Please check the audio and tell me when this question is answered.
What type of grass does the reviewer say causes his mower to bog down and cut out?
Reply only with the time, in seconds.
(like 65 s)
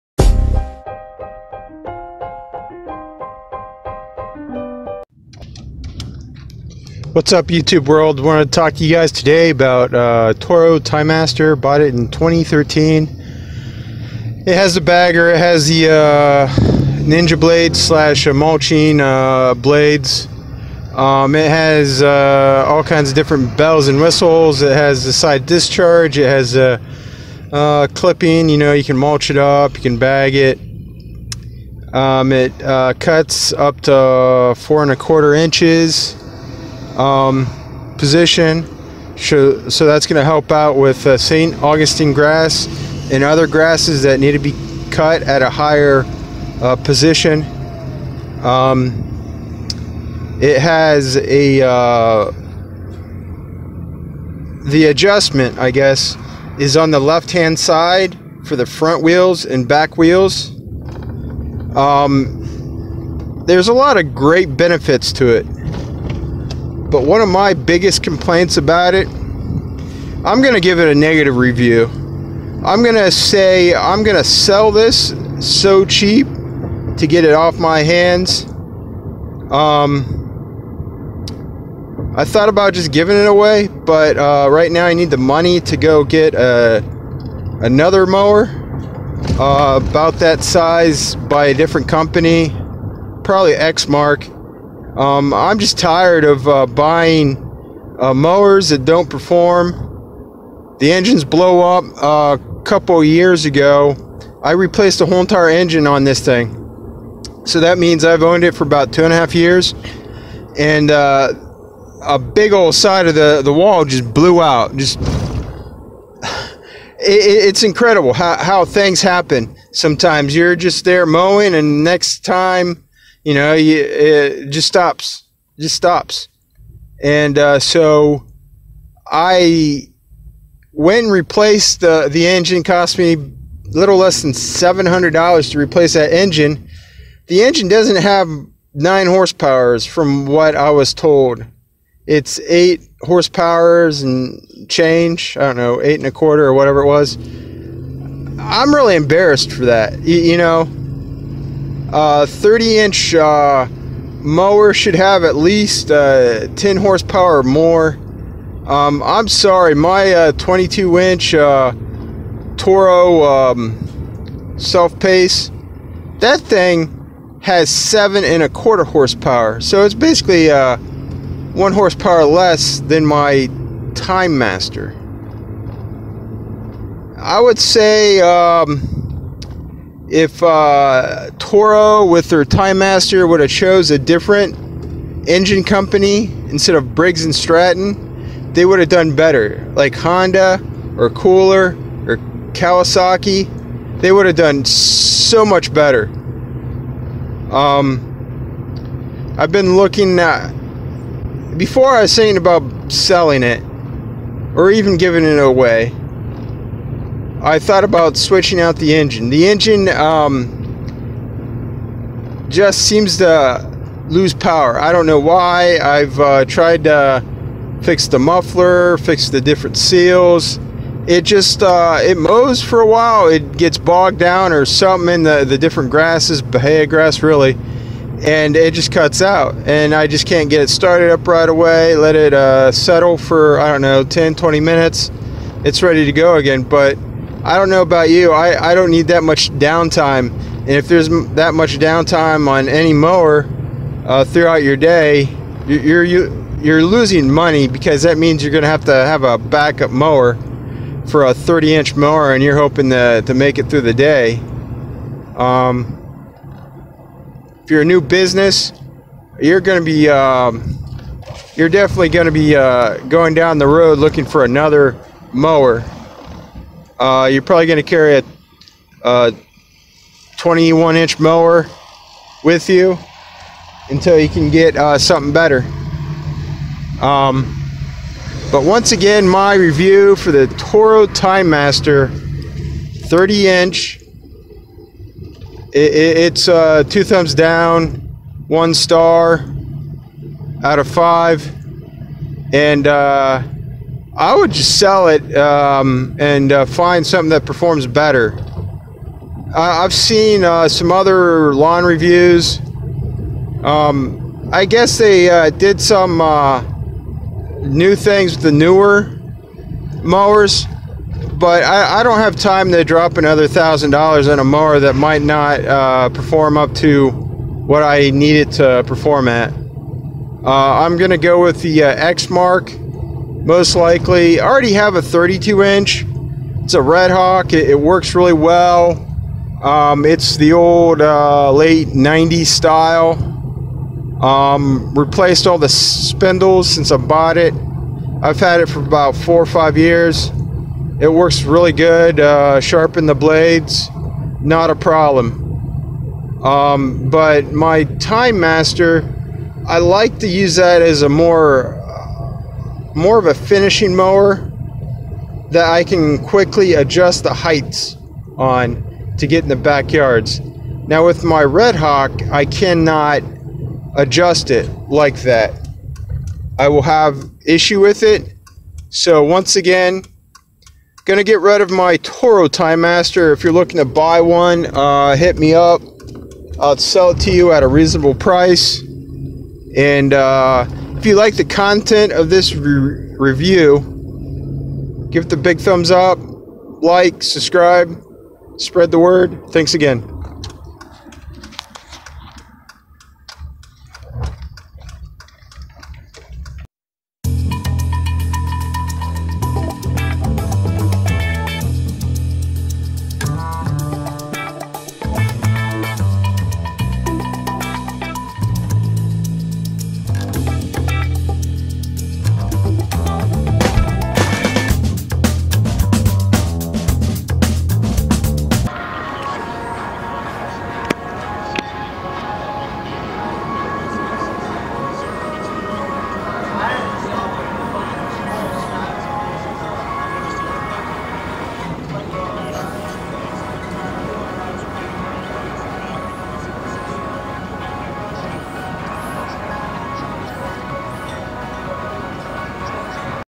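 226 s.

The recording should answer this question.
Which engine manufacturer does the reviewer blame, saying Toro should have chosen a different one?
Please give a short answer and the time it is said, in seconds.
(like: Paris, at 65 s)
Briggs and Stratton, at 186 s.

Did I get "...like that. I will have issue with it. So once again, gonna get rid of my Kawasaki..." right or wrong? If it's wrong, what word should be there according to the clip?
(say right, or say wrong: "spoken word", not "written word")
wrong: "Toro", not "Kawasaki".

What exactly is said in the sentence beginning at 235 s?
It's ready to go again, but I don't know about you.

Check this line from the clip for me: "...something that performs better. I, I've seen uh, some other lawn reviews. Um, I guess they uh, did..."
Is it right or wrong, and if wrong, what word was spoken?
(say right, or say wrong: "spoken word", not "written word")
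right.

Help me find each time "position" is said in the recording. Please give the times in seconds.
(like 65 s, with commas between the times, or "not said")
37 s, 46 s.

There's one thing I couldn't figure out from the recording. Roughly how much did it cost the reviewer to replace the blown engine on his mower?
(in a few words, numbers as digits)
Less than $700.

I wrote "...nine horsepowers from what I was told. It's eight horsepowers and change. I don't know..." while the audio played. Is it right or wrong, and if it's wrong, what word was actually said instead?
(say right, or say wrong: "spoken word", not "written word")
right.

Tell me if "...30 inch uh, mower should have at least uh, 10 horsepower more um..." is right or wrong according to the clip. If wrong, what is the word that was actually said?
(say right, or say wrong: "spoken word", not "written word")
right.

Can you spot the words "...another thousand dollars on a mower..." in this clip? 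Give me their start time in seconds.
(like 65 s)
313 s.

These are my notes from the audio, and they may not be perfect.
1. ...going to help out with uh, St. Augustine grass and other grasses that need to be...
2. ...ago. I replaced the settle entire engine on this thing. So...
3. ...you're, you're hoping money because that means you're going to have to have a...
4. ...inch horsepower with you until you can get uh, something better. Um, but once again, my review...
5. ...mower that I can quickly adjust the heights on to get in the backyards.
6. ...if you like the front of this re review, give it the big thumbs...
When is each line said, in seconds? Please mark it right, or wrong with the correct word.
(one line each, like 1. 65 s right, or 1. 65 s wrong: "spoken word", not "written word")
1. 40 s right
2. 103 s wrong: "whole", not "settle"
3. 246 s wrong: "losing", not "hoping"
4. 270 s wrong: "mower", not "horsepower"
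5. 353 s right
6. 381 s wrong: "content", not "front".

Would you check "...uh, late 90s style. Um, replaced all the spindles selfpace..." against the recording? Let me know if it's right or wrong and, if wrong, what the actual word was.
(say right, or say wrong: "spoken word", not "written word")
wrong: "since", not "selfpace".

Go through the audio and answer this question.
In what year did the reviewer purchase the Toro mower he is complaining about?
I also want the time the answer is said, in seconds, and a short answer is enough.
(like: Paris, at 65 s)
2013, at 12 s.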